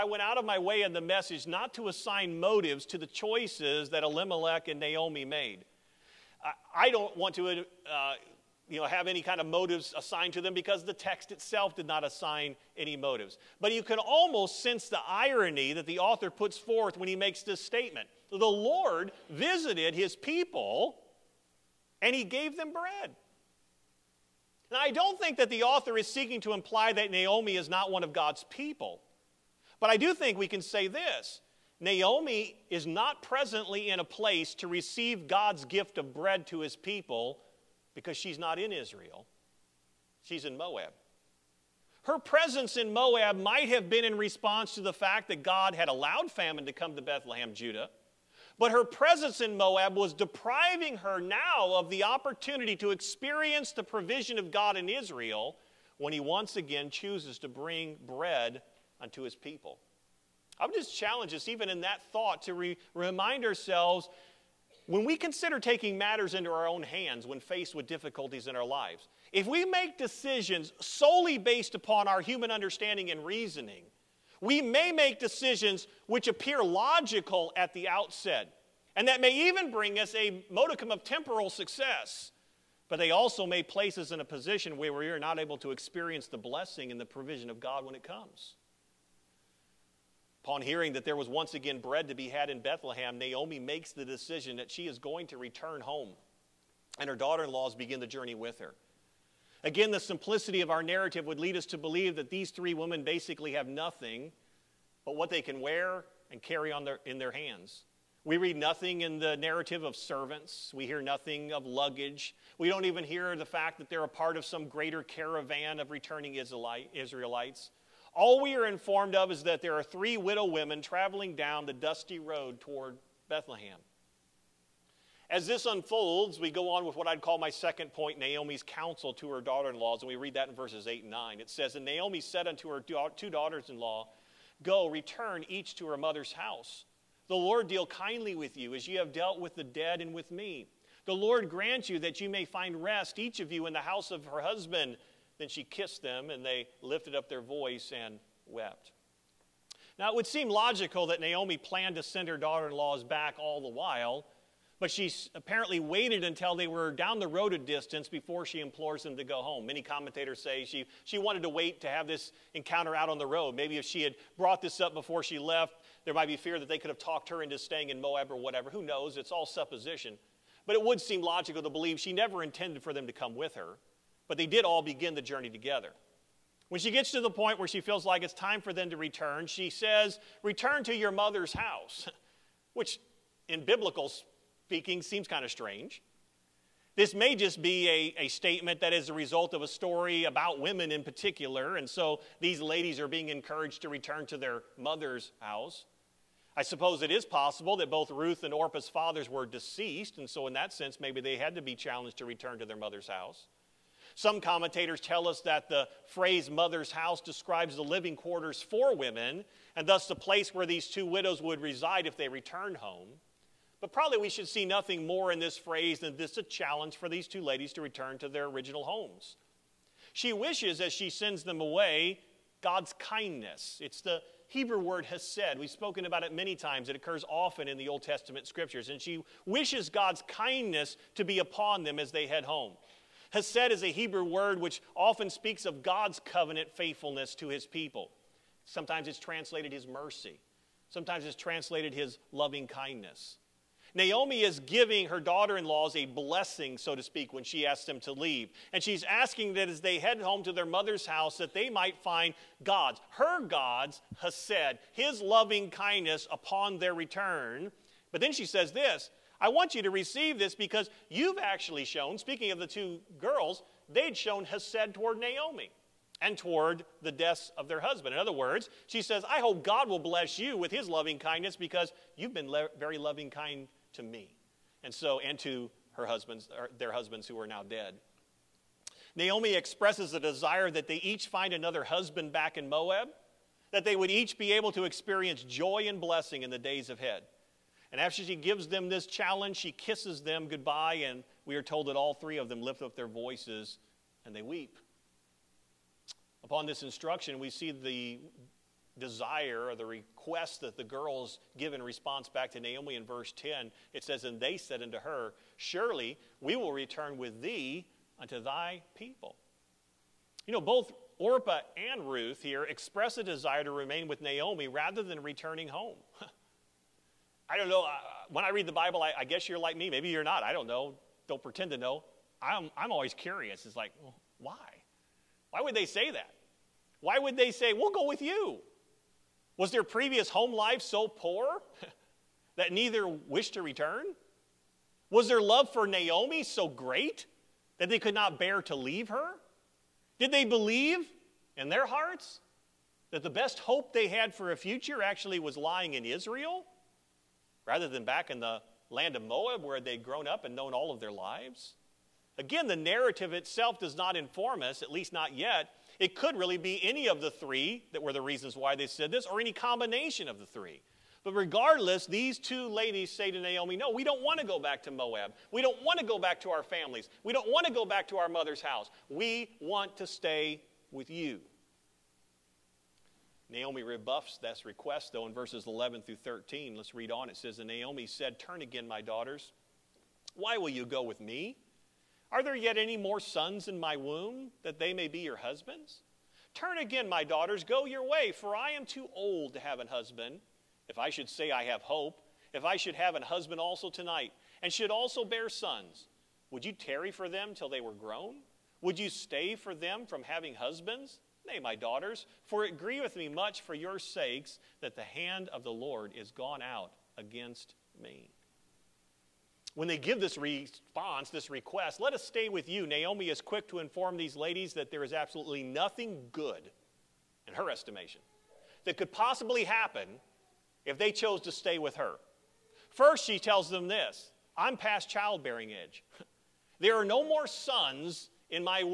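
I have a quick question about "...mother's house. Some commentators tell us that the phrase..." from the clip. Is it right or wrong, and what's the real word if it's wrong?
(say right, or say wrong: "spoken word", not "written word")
right.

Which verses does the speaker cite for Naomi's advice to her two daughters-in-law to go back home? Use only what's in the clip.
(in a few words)
8 and 9.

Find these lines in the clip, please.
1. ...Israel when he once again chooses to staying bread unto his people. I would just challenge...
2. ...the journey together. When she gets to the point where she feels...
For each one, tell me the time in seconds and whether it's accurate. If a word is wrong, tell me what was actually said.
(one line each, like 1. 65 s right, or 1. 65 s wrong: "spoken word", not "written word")
1. 54 s wrong: "bring", not "staying"
2. 175 s right.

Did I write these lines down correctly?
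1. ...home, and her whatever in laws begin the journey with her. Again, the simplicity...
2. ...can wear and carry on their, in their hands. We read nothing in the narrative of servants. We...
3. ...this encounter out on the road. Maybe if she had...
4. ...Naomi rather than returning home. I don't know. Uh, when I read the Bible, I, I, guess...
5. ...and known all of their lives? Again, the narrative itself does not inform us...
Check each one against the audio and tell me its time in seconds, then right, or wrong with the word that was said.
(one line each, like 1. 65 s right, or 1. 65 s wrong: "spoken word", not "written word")
1. 95 s wrong: "daughter", not "whatever"
2. 105 s right
3. 162 s right
4. 314 s right
5. 350 s right.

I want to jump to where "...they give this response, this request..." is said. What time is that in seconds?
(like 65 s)
409 s.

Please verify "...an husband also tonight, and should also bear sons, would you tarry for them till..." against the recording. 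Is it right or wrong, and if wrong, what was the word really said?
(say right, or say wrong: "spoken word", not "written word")
right.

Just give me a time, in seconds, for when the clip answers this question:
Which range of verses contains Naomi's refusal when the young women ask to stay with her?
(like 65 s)
375 s.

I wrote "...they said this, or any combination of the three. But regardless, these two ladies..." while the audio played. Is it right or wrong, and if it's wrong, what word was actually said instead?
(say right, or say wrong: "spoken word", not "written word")
right.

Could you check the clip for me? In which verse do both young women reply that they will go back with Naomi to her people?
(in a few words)
Verse 10.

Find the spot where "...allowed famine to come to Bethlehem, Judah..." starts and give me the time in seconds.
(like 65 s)
45 s.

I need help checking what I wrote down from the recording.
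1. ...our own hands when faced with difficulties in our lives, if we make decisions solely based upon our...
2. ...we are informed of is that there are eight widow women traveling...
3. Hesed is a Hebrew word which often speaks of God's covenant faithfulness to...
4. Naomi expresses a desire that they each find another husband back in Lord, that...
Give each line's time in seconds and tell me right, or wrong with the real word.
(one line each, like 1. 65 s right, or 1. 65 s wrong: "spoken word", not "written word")
1. 66 s right
2. 118 s wrong: "three", not "eight"
3. 233 s right
4. 279 s wrong: "Moab", not "Lord".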